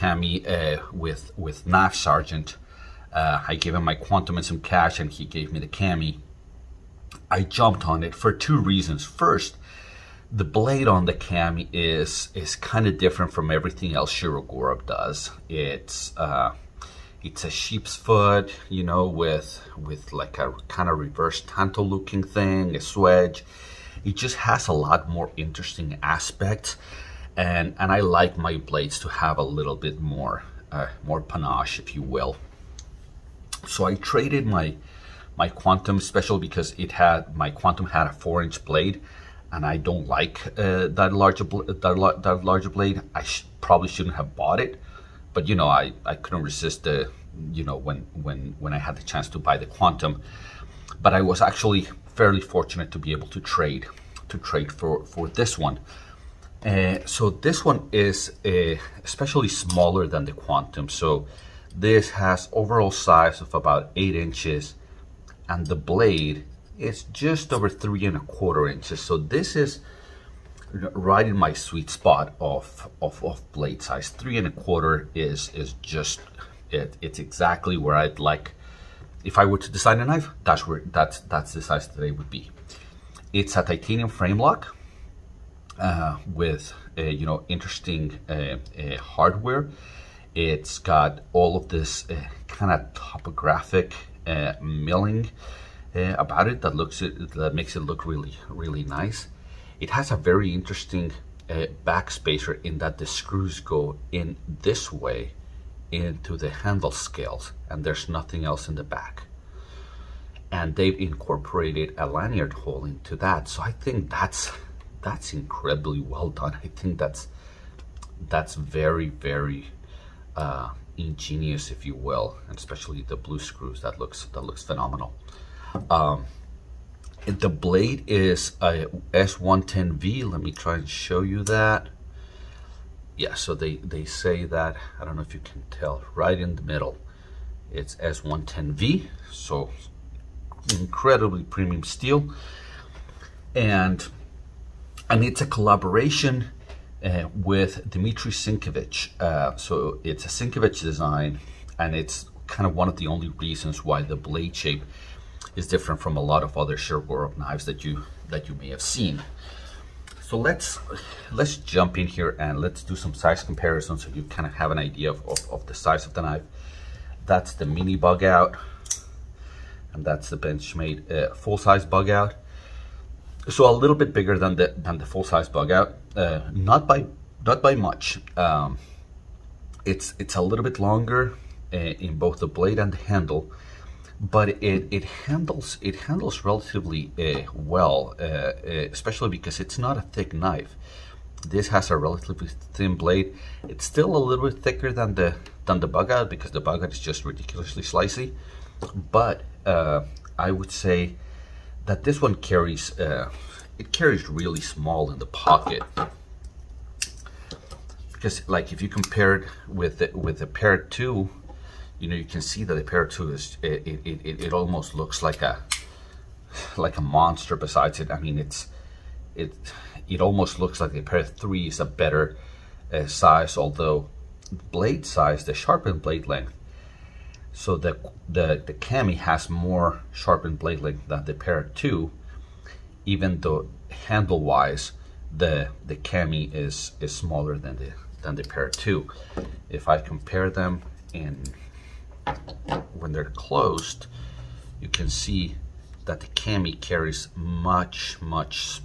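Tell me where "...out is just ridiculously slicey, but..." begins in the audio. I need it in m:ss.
3:16.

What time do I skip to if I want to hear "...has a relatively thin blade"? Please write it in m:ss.
3:11.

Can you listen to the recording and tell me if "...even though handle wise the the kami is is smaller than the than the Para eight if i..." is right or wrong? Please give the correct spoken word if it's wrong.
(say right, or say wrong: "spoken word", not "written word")
wrong: "two", not "eight".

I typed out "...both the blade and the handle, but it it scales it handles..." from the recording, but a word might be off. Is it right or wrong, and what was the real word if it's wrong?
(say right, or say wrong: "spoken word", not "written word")
wrong: "handles", not "scales".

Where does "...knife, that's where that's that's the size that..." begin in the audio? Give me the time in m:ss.
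1:20.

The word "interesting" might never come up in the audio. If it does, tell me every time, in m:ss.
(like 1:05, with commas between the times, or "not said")
0:25, 1:27, 1:40.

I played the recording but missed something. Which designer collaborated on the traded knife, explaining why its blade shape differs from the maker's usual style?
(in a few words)
Dmitry Sinkevich.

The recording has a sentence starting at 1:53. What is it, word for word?
So I think that's that's incredibly well done.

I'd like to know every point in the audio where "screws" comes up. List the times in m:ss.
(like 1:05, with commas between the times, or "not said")
1:43, 2:03.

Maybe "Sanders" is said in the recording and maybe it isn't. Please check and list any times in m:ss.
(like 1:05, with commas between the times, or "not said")
not said.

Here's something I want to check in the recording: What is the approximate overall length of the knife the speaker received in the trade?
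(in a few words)
8 inches.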